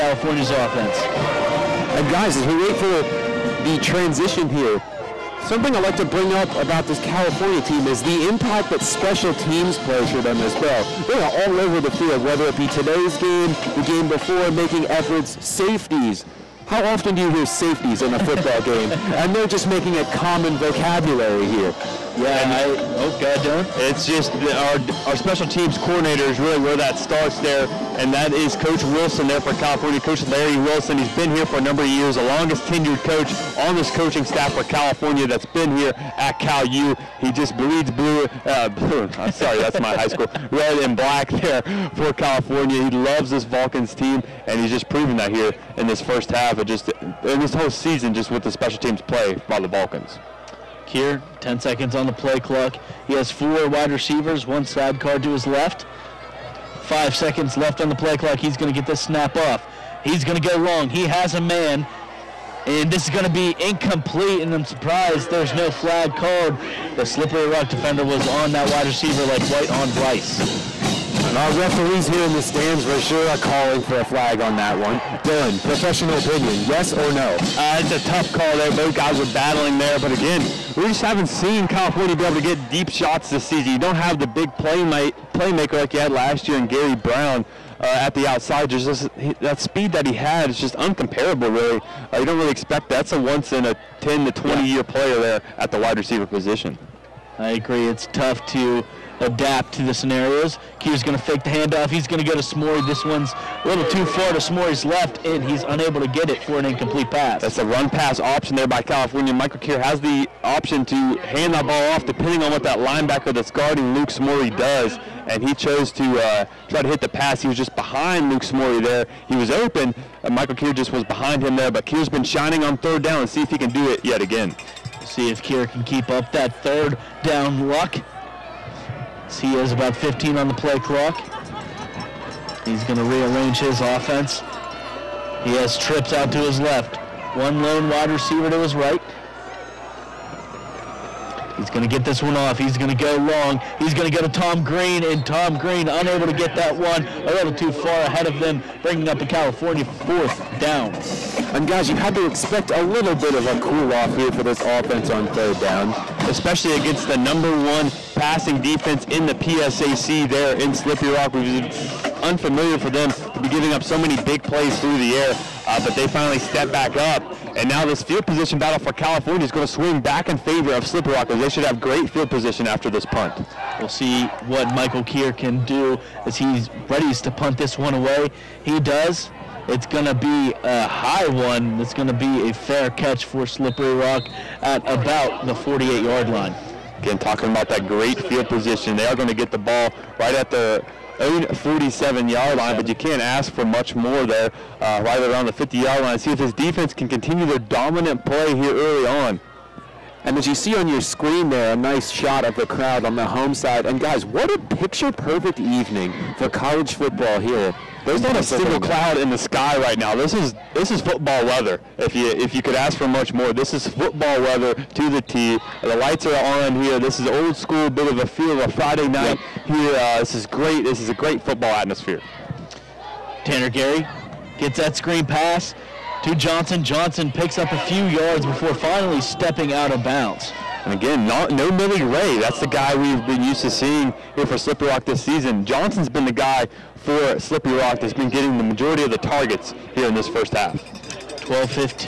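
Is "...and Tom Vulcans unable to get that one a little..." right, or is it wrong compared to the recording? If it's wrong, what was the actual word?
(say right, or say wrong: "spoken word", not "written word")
wrong: "Green", not "Vulcans".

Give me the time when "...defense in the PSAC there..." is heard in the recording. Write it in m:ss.
2:38.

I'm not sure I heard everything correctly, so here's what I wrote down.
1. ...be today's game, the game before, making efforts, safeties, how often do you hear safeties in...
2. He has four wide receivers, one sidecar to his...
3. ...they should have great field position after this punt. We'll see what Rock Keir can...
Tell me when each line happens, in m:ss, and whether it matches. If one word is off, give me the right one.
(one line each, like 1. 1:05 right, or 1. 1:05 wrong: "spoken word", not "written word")
1. 0:12 right
2. 0:53 right
3. 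2:51 wrong: "Michael", not "Rock".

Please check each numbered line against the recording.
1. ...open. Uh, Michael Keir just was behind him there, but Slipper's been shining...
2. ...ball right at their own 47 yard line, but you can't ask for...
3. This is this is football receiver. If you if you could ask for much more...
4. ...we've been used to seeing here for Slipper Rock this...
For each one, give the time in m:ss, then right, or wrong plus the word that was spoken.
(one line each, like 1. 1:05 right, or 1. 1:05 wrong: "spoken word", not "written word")
1. 1:59 wrong: "Keir", not "Slipper"
2. 3:09 right
3. 3:30 wrong: "weather", not "receiver"
4. 3:52 right.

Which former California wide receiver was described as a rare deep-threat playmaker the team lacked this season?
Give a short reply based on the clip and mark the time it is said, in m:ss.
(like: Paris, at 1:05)
Gary Brown, at 1:26.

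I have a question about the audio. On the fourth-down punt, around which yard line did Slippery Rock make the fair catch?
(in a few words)
48.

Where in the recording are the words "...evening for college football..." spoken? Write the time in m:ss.
3:25.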